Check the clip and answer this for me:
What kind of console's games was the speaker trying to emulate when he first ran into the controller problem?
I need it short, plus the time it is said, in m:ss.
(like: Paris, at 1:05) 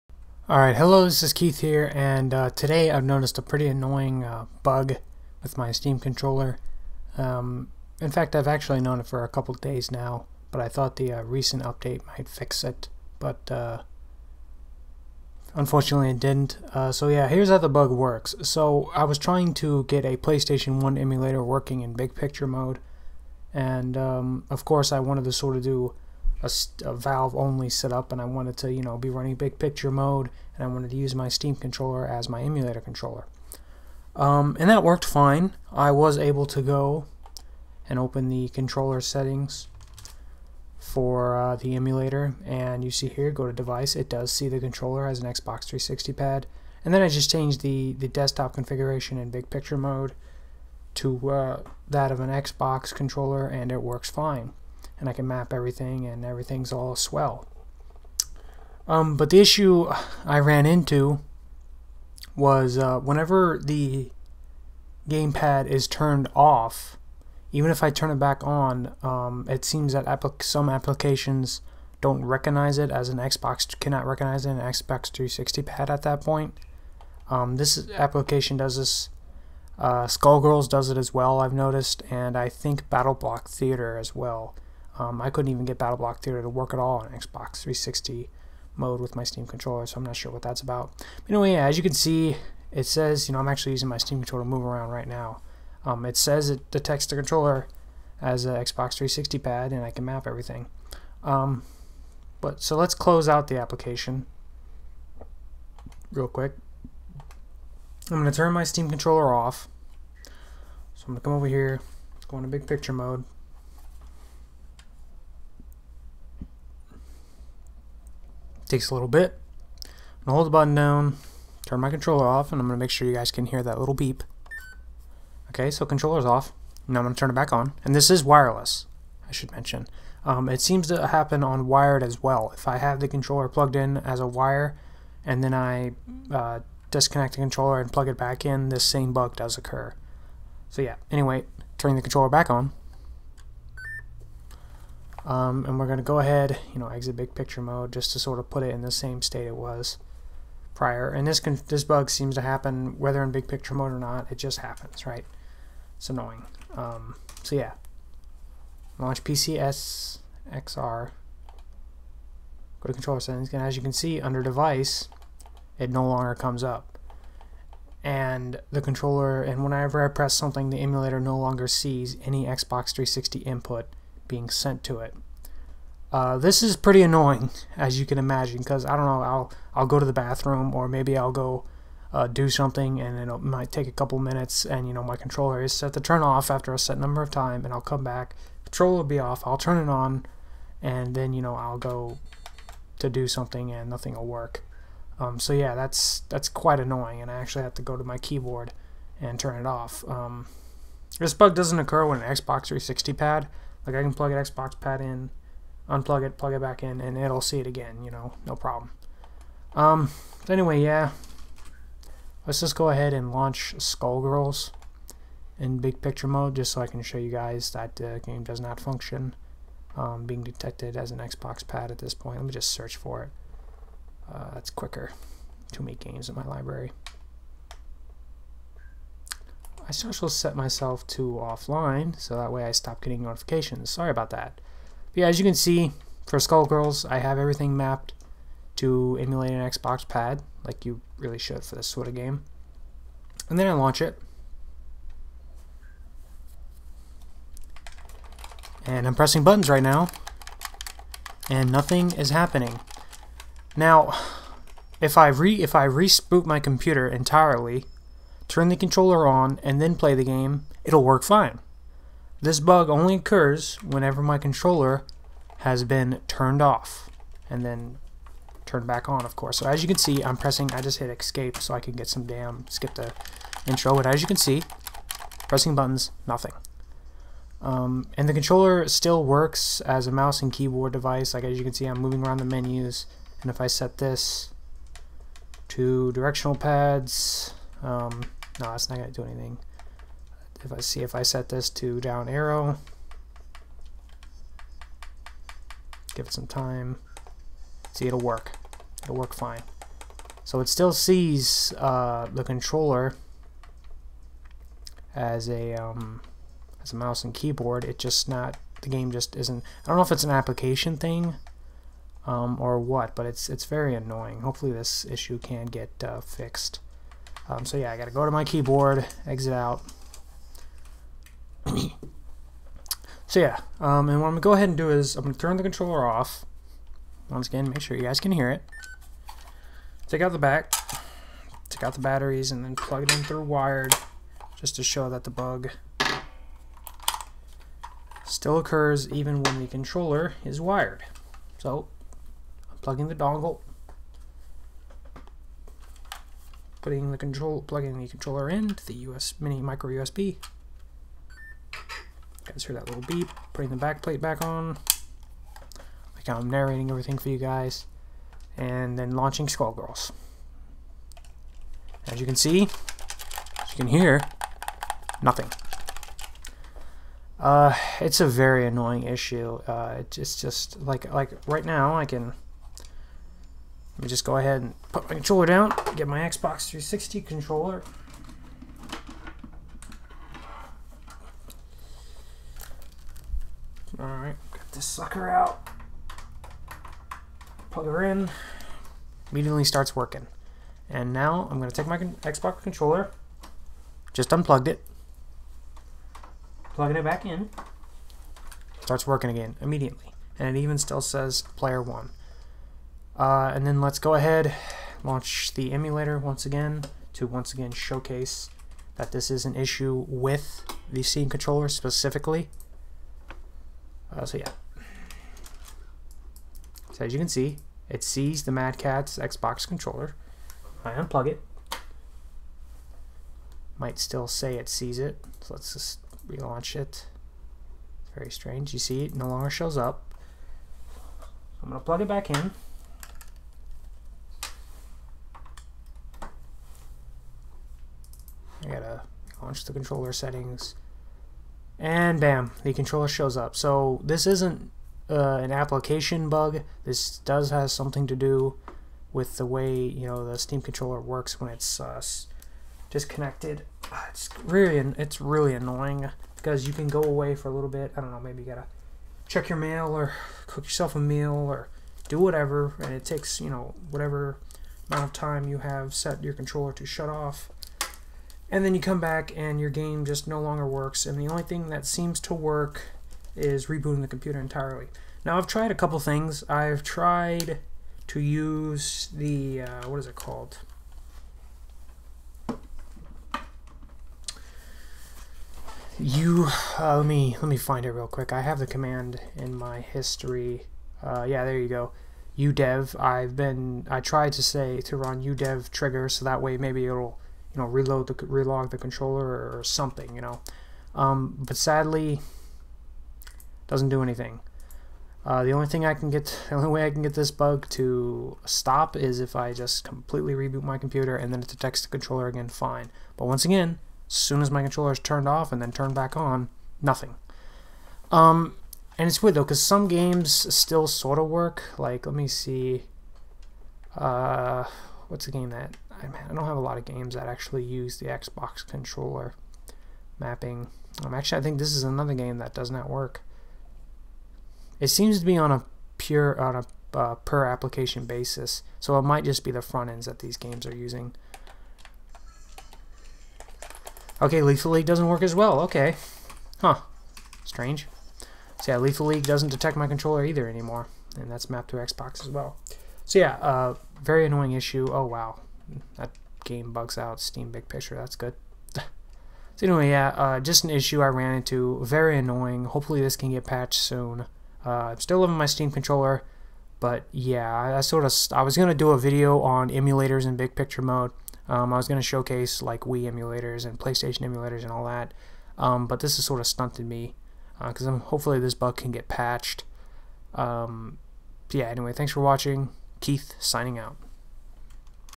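PlayStation 1, at 0:20.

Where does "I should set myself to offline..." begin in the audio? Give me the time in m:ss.
3:49.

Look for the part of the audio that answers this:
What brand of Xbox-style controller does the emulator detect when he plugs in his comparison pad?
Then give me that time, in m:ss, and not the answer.
6:58.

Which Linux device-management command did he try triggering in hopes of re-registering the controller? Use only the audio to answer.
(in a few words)
udev trigger.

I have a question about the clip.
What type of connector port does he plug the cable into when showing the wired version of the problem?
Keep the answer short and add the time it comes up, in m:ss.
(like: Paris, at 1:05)
Micro USB, at 5:49.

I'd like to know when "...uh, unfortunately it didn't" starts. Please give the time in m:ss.
0:13.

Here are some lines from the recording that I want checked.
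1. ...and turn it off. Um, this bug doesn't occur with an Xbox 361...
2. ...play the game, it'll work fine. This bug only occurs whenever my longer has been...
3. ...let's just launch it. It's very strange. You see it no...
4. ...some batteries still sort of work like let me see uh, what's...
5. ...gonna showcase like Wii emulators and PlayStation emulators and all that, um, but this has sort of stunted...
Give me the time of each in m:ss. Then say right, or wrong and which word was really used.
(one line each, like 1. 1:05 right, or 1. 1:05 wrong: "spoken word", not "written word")
1. 3:19 wrong: "360", not "361"
2. 4:19 wrong: "controller", not "longer"
3. 7:05 wrong: "relaunch", not "launch"
4. 8:39 wrong: "games", not "batteries"
5. 9:31 right.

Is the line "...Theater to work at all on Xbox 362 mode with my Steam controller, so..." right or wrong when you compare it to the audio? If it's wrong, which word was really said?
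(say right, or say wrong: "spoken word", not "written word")
wrong: "360", not "362".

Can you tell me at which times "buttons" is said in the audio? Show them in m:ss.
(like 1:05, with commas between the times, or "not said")
2:00, 4:09, 4:35.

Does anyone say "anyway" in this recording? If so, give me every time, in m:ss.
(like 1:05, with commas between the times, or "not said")
1:31, 2:21, 3:30, 9:19, 9:41.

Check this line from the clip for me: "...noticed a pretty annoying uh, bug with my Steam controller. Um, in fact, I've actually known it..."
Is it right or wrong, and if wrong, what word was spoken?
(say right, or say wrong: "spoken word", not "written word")
right.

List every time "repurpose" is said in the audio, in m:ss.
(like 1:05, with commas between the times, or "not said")
not said.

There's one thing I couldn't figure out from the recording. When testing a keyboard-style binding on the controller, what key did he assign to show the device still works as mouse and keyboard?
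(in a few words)
Down arrow.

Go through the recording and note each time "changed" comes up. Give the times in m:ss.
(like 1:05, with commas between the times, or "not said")
0:47.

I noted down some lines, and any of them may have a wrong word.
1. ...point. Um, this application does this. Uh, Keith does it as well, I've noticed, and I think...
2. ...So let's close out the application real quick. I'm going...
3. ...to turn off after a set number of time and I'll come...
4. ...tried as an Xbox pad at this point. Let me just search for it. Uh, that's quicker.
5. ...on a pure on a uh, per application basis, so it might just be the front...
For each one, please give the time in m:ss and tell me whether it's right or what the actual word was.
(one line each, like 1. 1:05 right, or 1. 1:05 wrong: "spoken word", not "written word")
1. 1:16 wrong: "Skullgirls", not "Keith"
2. 1:42 right
3. 3:05 right
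4. 3:40 wrong: "detected", not "tried"
5. 8:55 right.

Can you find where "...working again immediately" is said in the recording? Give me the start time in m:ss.
6:39.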